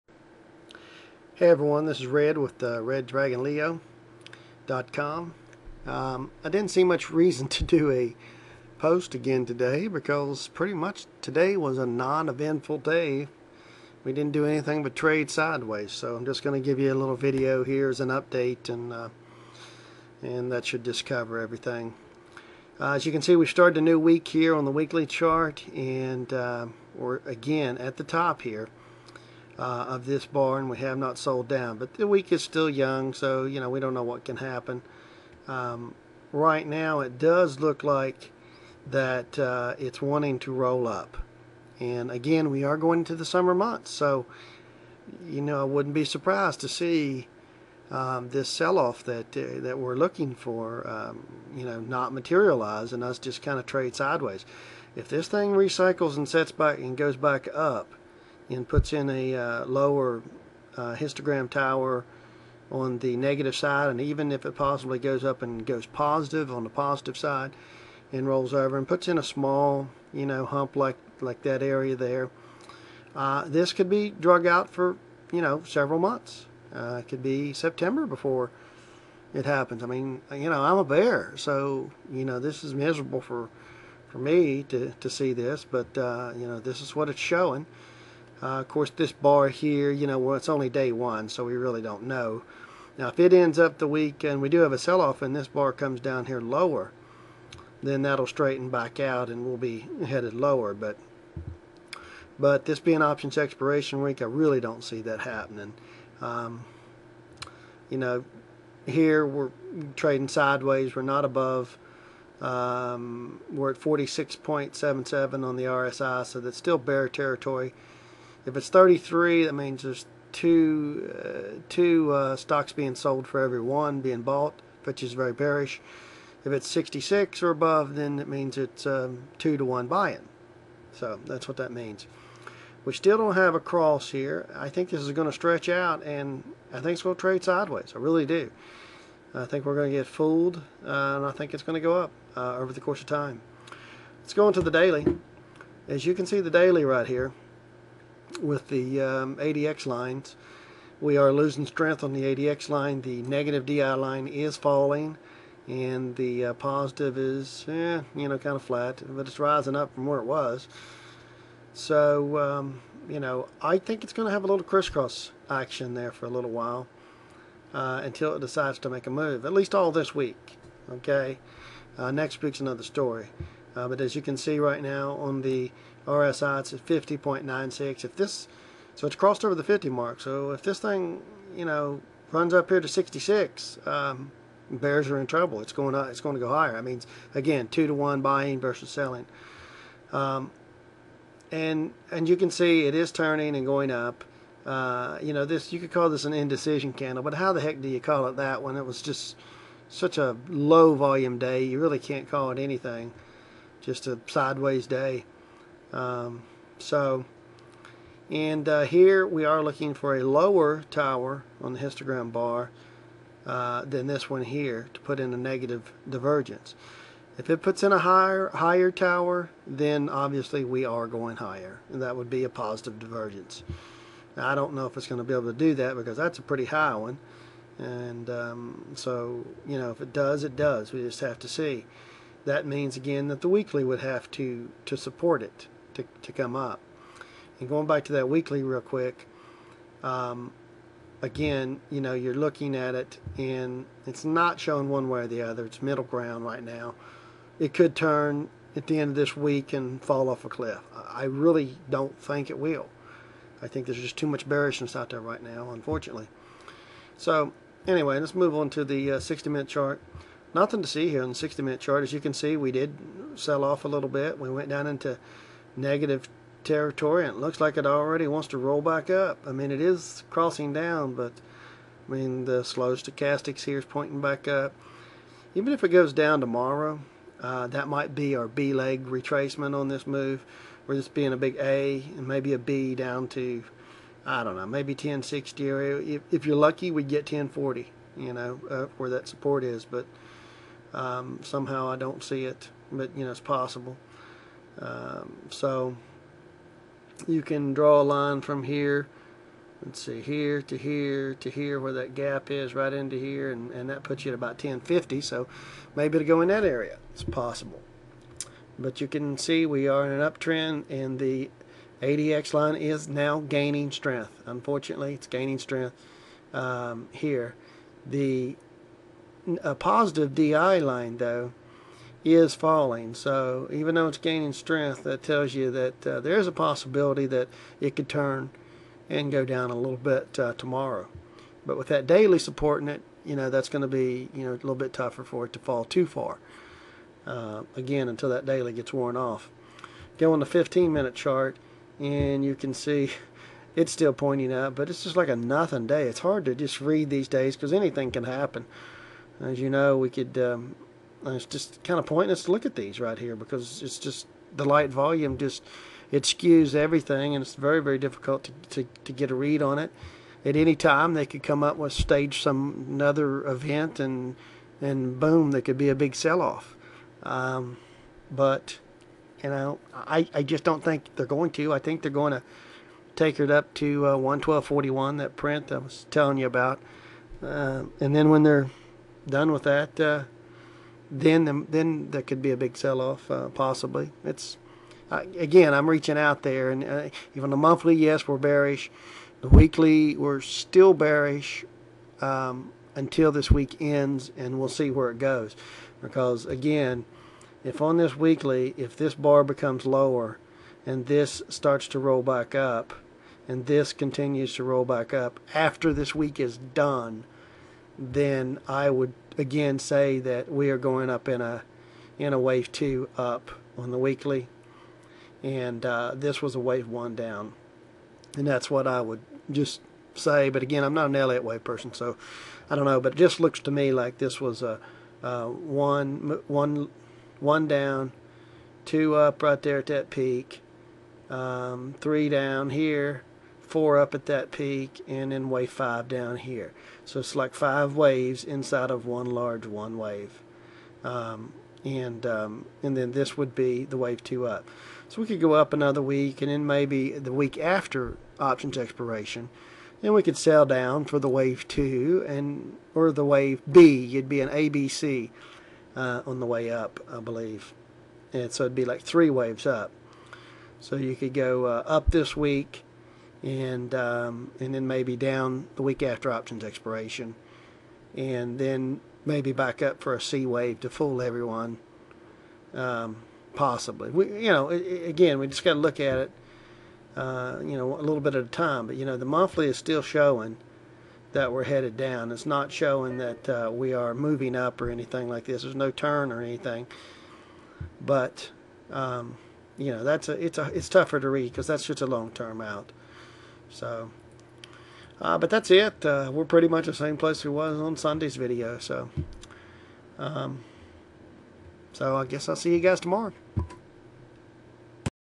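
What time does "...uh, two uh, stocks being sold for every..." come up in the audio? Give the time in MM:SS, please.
02:01.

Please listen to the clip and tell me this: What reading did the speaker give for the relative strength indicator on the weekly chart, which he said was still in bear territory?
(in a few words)
46.77.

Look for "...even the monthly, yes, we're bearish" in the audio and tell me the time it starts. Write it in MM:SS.
06:27.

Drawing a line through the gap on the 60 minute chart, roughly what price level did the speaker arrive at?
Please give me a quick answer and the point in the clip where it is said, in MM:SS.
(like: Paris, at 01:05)
1050, at 05:04.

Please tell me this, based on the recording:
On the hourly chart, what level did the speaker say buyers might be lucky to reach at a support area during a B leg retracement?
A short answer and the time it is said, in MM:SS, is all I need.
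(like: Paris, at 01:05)
1040, at 04:47.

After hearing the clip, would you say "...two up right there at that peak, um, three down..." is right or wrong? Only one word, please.
right.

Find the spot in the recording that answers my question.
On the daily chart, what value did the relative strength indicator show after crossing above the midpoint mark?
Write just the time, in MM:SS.
02:56.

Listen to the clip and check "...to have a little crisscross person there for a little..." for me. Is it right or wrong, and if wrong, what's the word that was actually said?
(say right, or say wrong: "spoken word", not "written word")
wrong: "action", not "person".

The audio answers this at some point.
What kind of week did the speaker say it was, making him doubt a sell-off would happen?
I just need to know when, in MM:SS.
01:43.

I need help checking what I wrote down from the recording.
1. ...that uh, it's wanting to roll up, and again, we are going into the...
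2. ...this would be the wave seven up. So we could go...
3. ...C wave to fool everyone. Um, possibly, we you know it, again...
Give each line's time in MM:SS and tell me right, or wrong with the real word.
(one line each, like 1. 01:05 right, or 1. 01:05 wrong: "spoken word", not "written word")
1. 00:38 right
2. 07:23 wrong: "two", not "seven"
3. 07:50 right.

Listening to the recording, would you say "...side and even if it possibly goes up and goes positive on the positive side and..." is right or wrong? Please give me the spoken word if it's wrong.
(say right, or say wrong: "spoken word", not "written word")
right.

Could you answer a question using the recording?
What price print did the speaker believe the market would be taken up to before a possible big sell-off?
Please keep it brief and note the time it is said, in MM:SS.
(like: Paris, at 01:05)
112.41, at 06:14.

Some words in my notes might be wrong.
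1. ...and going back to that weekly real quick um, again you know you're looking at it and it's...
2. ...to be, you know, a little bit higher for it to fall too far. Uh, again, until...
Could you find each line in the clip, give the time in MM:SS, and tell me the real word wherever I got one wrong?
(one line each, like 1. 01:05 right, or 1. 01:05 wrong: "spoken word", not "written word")
1. 03:57 right
2. 05:33 wrong: "tougher", not "higher".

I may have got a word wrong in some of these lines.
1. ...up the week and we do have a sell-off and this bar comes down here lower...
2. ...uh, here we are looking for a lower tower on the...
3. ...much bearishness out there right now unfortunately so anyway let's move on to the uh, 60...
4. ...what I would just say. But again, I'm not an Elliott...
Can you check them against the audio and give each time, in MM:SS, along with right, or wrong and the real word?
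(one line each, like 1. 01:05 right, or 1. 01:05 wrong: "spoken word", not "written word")
1. 01:33 right
2. 03:28 right
3. 04:14 right
4. 06:58 right.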